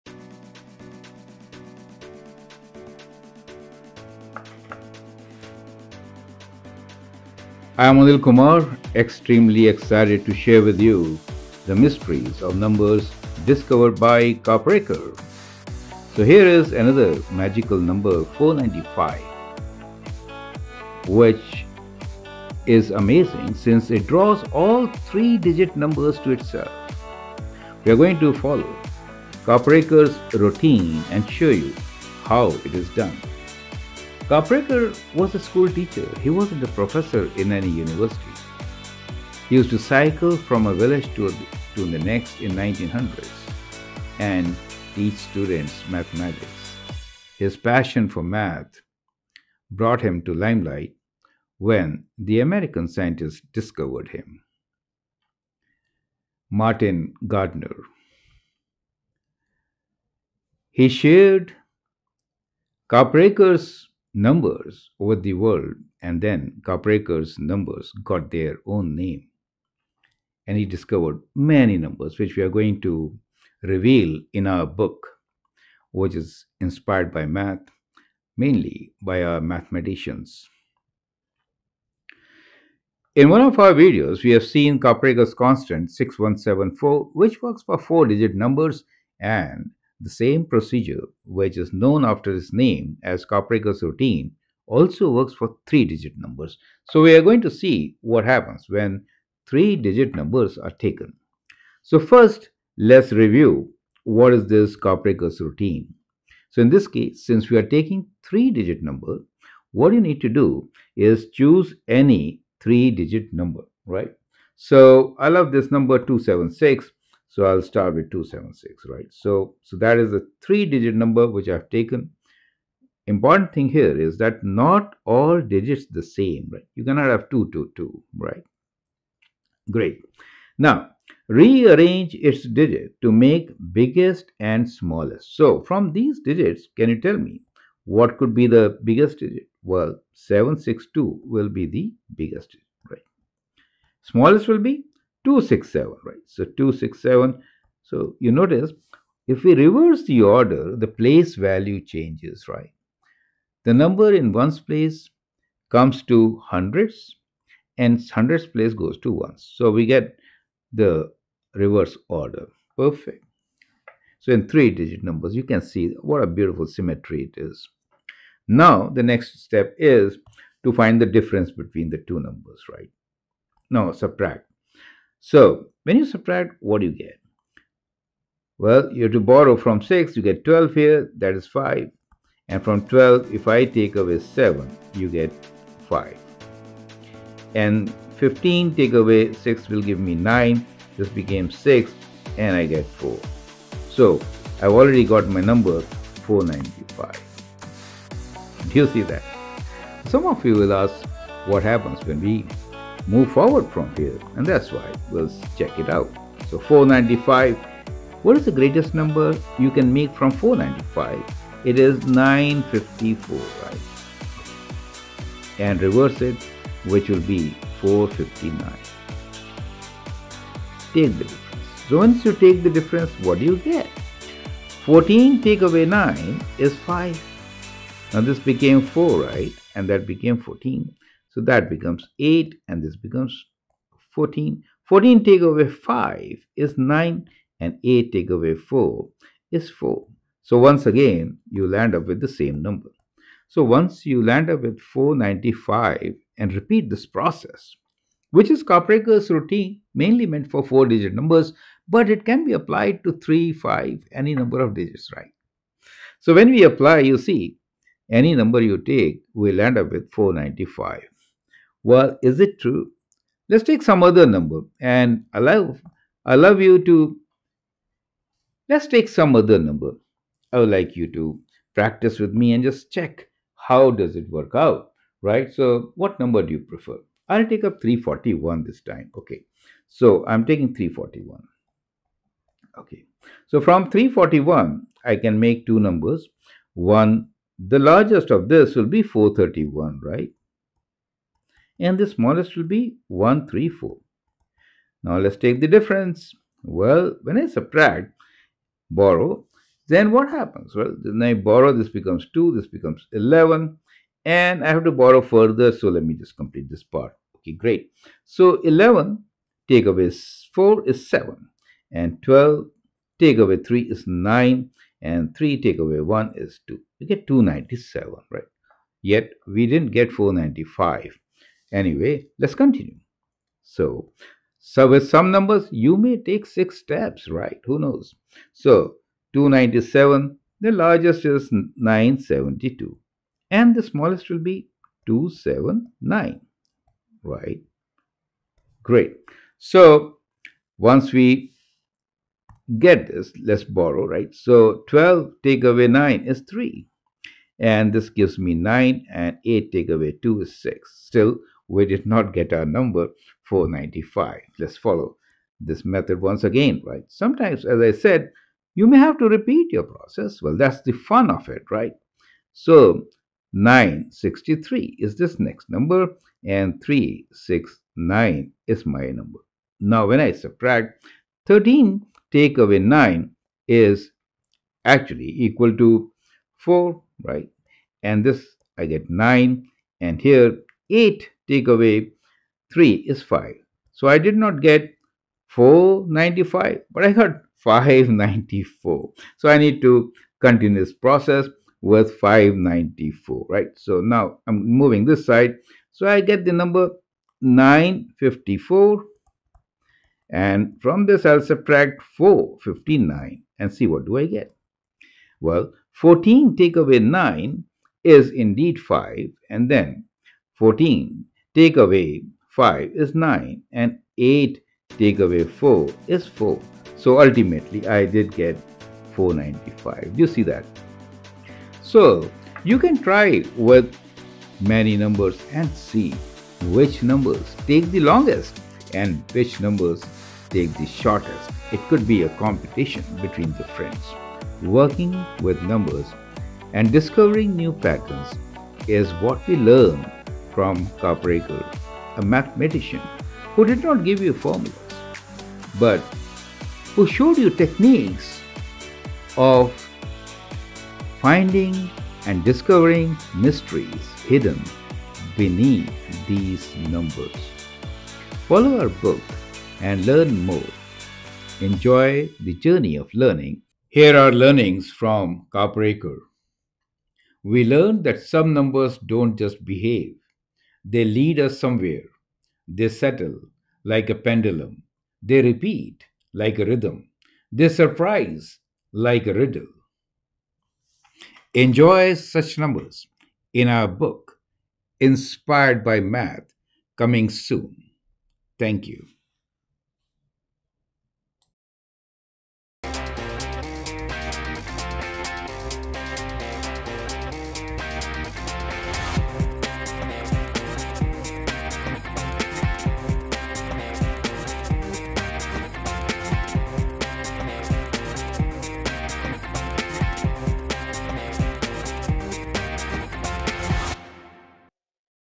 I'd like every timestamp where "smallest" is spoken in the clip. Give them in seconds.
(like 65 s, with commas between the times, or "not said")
134 s, 144 s, 292 s, 333 s.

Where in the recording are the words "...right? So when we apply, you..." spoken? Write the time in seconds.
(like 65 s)
255 s.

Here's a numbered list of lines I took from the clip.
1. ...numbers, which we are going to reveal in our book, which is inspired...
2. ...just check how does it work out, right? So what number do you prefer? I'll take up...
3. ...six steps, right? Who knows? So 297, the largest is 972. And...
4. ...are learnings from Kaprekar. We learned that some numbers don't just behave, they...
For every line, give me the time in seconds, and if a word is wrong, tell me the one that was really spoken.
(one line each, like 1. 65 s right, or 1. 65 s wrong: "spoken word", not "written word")
1. 71 s right
2. 272 s right
3. 326 s right
4. 464 s right.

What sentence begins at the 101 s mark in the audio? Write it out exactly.
So first, let's review what is this Kaprekar's routine.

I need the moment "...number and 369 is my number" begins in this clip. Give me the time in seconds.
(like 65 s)
365 s.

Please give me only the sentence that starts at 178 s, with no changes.
Well, you have to borrow from 6, you get 12 here, that is 5.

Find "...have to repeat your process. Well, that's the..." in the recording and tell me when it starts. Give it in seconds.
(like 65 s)
358 s.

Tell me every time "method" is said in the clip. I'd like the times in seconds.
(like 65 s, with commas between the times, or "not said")
355 s.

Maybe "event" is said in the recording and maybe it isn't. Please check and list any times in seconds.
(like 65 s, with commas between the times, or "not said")
not said.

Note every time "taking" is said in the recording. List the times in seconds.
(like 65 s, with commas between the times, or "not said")
107 s, 280 s.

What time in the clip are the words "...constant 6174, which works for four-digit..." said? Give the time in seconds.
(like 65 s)
85 s.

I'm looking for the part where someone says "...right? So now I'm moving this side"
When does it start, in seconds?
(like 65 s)
393 s.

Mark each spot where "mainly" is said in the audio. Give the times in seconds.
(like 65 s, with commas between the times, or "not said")
78 s, 249 s.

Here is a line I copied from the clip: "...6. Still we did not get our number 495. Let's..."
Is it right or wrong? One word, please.
right.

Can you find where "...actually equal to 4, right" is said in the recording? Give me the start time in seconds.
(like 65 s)
374 s.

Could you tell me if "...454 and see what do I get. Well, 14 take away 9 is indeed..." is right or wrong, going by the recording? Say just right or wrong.
wrong.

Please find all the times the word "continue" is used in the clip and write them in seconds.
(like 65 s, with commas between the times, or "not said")
322 s, 390 s.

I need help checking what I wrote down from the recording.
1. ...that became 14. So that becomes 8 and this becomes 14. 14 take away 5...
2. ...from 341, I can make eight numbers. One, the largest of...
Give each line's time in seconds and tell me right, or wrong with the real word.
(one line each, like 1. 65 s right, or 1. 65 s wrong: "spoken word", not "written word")
1. 229 s right
2. 283 s wrong: "two", not "eight".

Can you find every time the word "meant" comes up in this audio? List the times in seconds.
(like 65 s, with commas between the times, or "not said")
250 s.